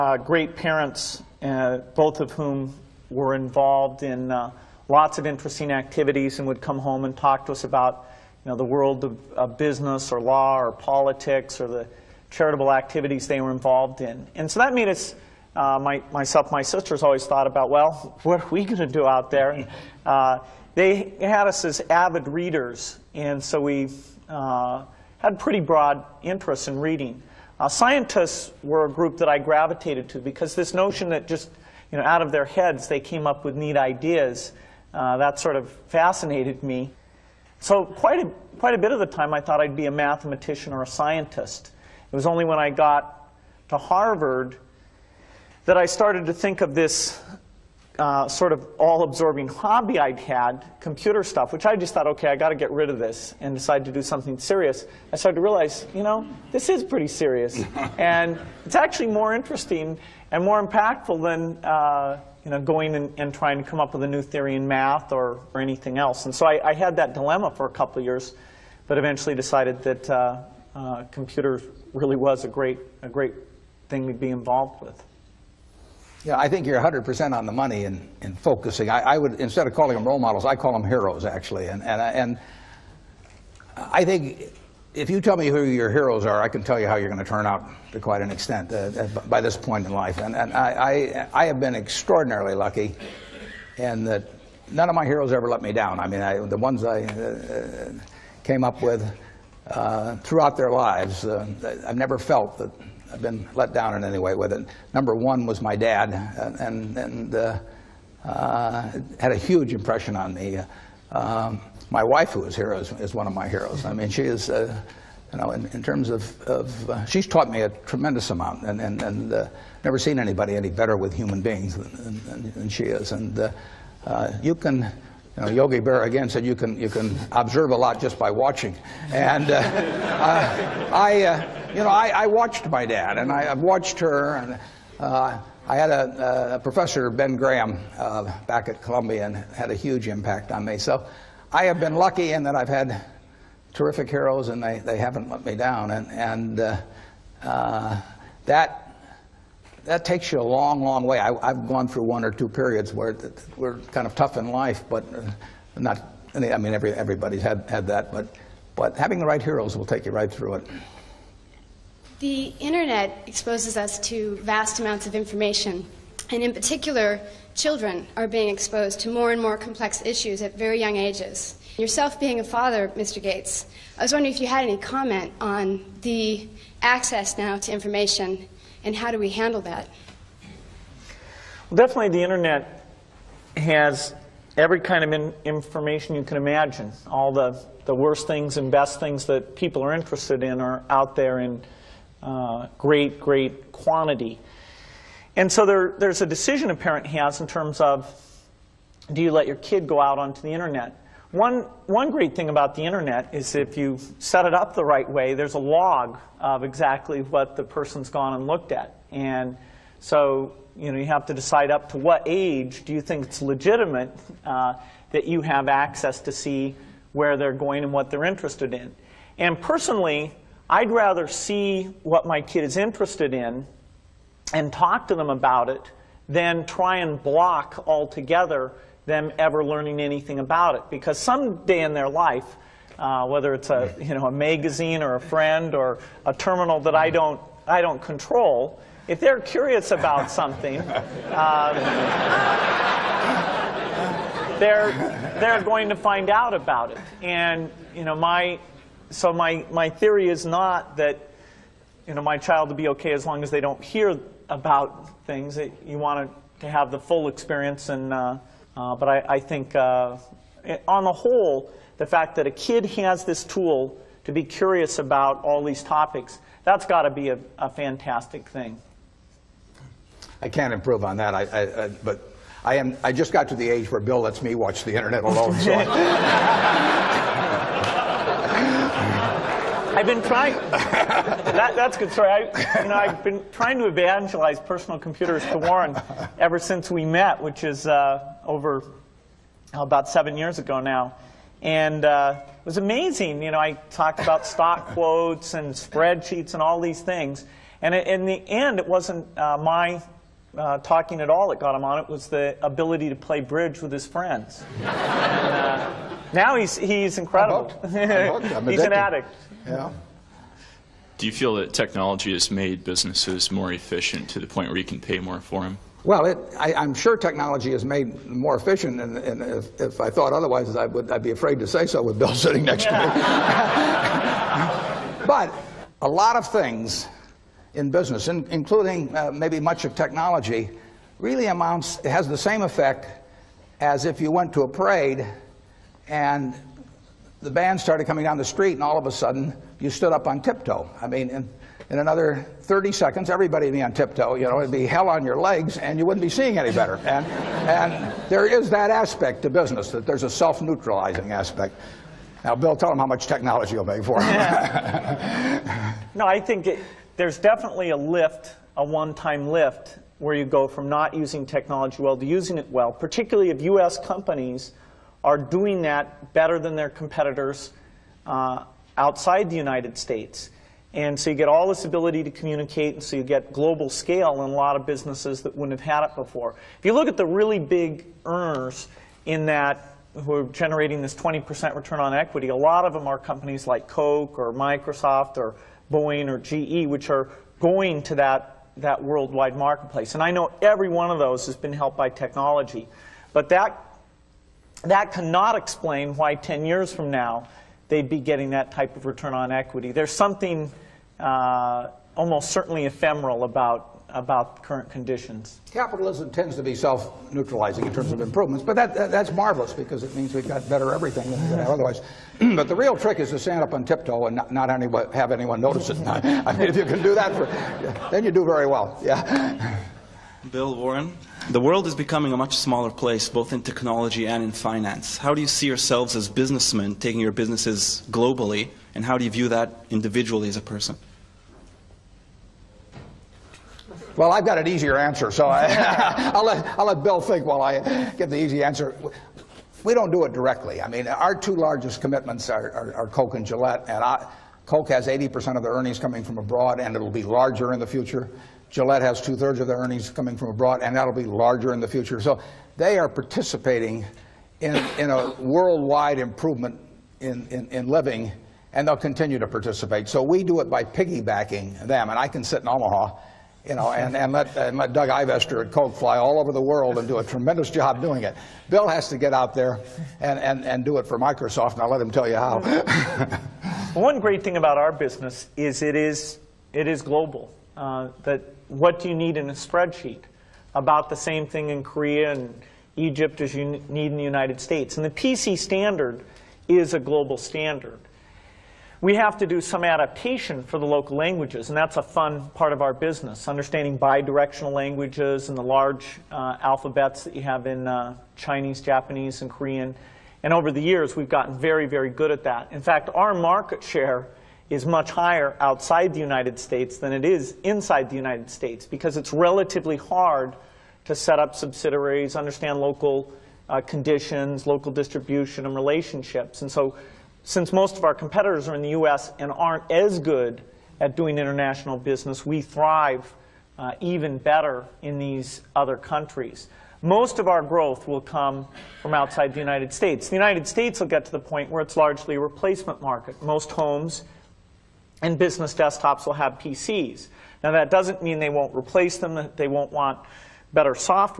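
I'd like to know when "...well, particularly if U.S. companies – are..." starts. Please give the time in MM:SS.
06:02.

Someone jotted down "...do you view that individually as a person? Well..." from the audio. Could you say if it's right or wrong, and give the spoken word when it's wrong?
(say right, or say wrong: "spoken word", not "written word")
right.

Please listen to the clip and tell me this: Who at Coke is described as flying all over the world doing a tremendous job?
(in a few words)
Doug Ivester.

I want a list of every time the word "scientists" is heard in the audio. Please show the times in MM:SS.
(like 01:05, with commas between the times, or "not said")
00:27, 00:40.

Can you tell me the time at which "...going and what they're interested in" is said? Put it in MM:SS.
03:37.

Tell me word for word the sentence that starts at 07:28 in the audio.
Gillette has two-thirds of their earnings coming from abroad, and that'll be larger in the future.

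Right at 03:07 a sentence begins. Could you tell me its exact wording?
All the, the worst things and best things that people are interested in are out there in uh, great, great quantity.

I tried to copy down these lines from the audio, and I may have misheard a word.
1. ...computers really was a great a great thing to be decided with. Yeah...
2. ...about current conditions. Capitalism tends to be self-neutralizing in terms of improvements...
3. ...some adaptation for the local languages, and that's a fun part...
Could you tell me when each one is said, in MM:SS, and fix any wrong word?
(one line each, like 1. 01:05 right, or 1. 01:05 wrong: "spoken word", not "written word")
1. 01:11 wrong: "involved", not "decided"
2. 06:44 right
3. 08:09 right.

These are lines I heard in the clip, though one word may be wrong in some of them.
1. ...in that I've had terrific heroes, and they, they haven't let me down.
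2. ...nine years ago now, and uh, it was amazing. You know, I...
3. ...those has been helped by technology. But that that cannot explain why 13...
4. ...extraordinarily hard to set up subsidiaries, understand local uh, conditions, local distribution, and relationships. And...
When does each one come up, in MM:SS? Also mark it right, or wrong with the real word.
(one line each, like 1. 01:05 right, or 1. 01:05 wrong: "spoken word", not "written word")
1. 02:22 right
2. 04:50 wrong: "seven", not "nine"
3. 06:31 wrong: "10", not "13"
4. 08:29 wrong: "relatively", not "extraordinarily".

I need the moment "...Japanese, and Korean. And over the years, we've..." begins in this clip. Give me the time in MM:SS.
08:18.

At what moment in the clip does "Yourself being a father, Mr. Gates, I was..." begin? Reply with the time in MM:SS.
02:51.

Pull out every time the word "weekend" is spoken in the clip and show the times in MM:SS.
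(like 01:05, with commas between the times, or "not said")
not said.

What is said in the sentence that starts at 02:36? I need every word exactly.
I mean, every, everybody's had, had that, but, but having the right heroes will take you right through it.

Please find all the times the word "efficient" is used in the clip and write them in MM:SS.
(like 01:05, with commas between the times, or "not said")
05:13, 05:18.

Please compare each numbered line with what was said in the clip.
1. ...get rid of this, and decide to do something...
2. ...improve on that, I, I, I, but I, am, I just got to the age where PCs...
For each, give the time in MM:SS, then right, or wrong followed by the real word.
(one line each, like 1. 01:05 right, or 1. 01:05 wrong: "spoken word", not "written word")
1. 00:52 right
2. 04:30 wrong: "Bill", not "PCs".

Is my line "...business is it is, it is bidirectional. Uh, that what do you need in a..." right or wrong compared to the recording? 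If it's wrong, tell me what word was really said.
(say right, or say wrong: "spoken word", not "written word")
wrong: "global", not "bidirectional".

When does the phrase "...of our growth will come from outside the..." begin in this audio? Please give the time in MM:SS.
08:47.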